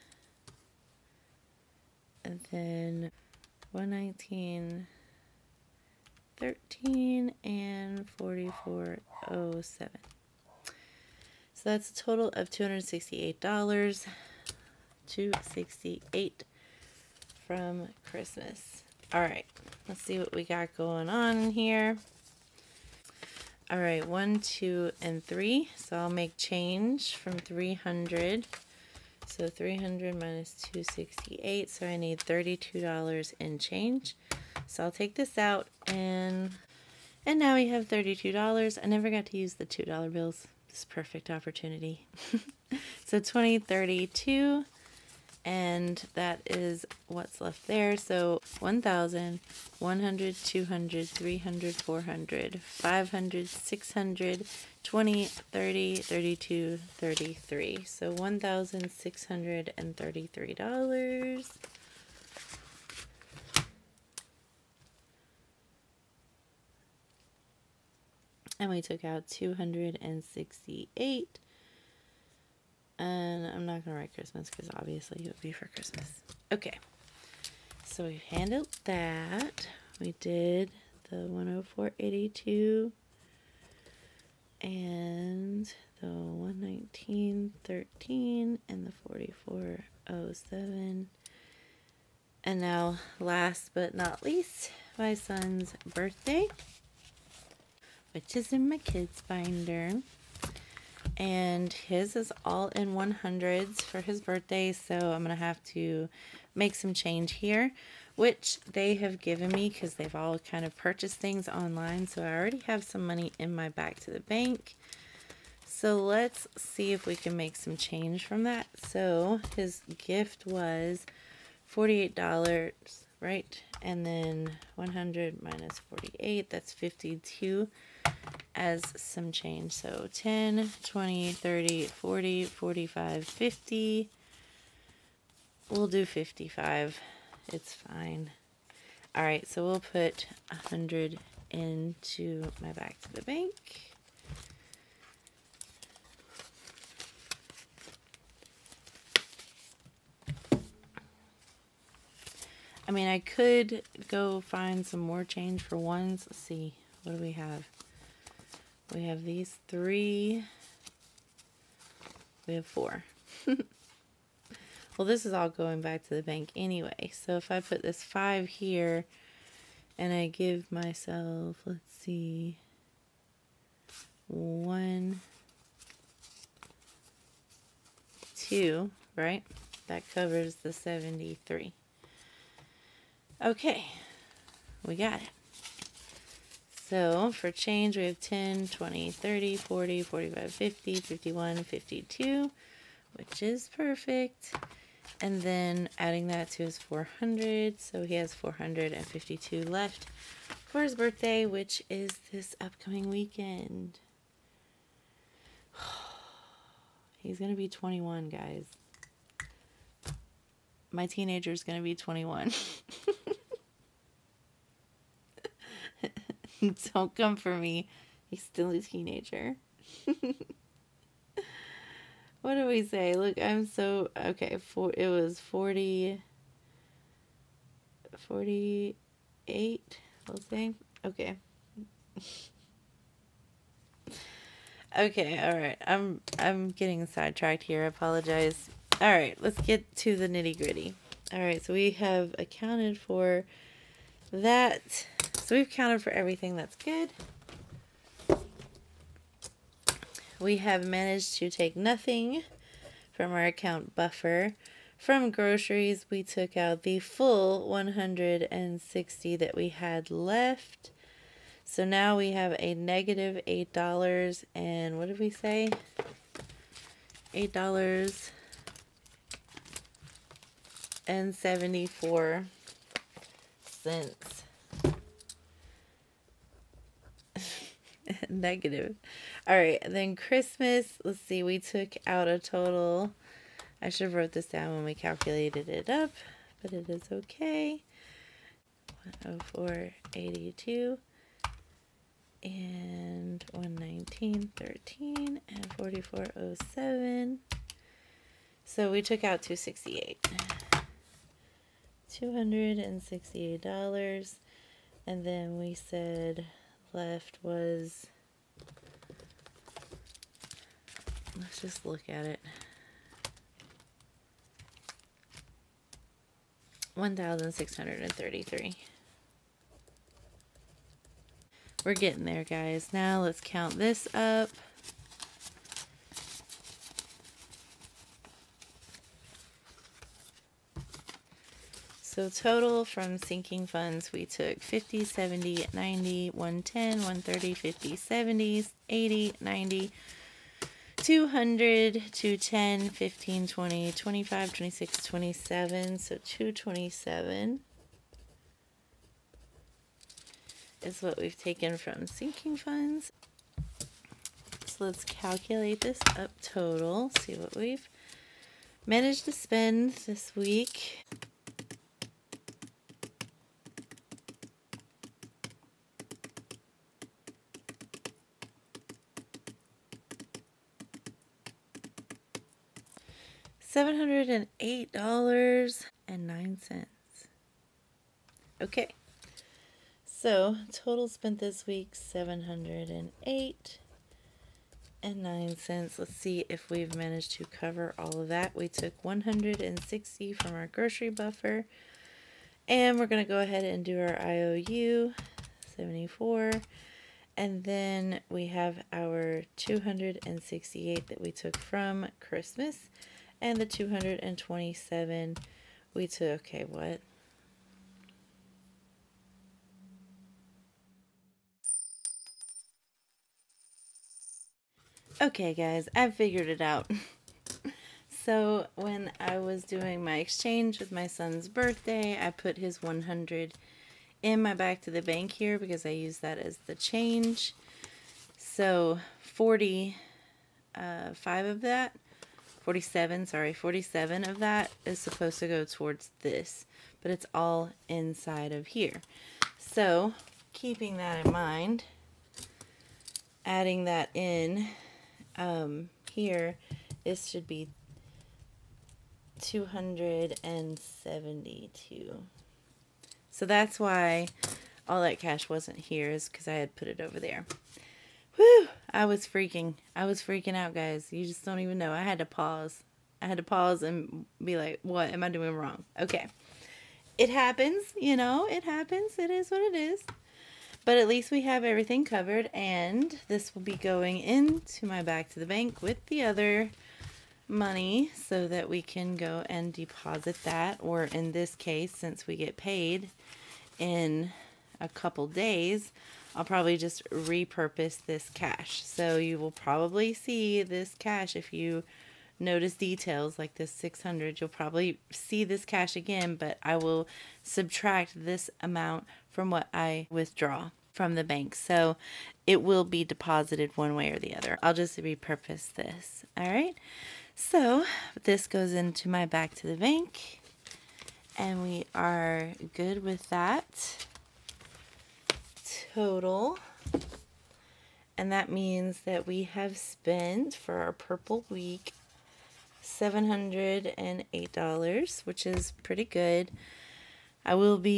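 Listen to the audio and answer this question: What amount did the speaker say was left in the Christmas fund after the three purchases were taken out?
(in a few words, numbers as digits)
1,633.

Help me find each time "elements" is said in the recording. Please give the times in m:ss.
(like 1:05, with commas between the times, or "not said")
not said.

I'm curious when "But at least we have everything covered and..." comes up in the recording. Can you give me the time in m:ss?
7:50.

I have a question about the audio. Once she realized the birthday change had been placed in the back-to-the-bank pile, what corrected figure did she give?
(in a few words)
272.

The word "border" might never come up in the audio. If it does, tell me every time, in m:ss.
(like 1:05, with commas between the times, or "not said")
not said.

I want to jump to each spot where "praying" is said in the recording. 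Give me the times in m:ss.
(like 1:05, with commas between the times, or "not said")
not said.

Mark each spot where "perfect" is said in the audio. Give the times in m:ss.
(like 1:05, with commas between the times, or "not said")
0:40, 3:13.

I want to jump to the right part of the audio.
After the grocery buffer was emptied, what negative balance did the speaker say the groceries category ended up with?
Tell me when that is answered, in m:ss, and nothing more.
4:27.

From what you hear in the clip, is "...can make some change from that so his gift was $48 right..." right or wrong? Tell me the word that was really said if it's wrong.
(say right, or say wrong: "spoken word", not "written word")
right.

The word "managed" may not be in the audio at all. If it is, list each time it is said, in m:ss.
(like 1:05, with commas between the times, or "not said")
4:10, 5:58, 6:26.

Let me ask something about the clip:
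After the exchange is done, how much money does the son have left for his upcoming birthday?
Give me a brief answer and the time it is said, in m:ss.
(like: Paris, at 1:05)
$452, at 3:18.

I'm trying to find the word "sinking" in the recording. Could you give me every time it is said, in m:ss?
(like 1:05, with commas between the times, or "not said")
5:33, 5:52.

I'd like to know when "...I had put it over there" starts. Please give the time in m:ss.
7:36.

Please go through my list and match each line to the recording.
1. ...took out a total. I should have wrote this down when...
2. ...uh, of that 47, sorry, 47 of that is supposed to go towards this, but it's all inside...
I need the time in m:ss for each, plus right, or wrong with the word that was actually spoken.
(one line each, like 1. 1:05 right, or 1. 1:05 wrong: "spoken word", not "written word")
1. 4:41 right
2. 7:11 right.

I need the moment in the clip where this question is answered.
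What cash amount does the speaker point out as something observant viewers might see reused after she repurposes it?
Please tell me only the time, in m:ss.
8:13.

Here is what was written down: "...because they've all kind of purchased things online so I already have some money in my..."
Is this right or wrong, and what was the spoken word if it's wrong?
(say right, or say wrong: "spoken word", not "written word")
right.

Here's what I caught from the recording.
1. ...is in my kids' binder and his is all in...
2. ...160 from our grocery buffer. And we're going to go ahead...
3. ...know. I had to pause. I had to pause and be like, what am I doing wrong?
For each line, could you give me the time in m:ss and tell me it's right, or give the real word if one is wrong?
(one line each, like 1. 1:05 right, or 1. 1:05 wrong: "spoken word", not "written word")
1. 1:38 right
2. 6:29 right
3. 7:41 right.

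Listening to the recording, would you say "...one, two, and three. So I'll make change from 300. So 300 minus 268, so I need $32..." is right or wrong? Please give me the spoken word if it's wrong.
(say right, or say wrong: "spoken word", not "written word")
right.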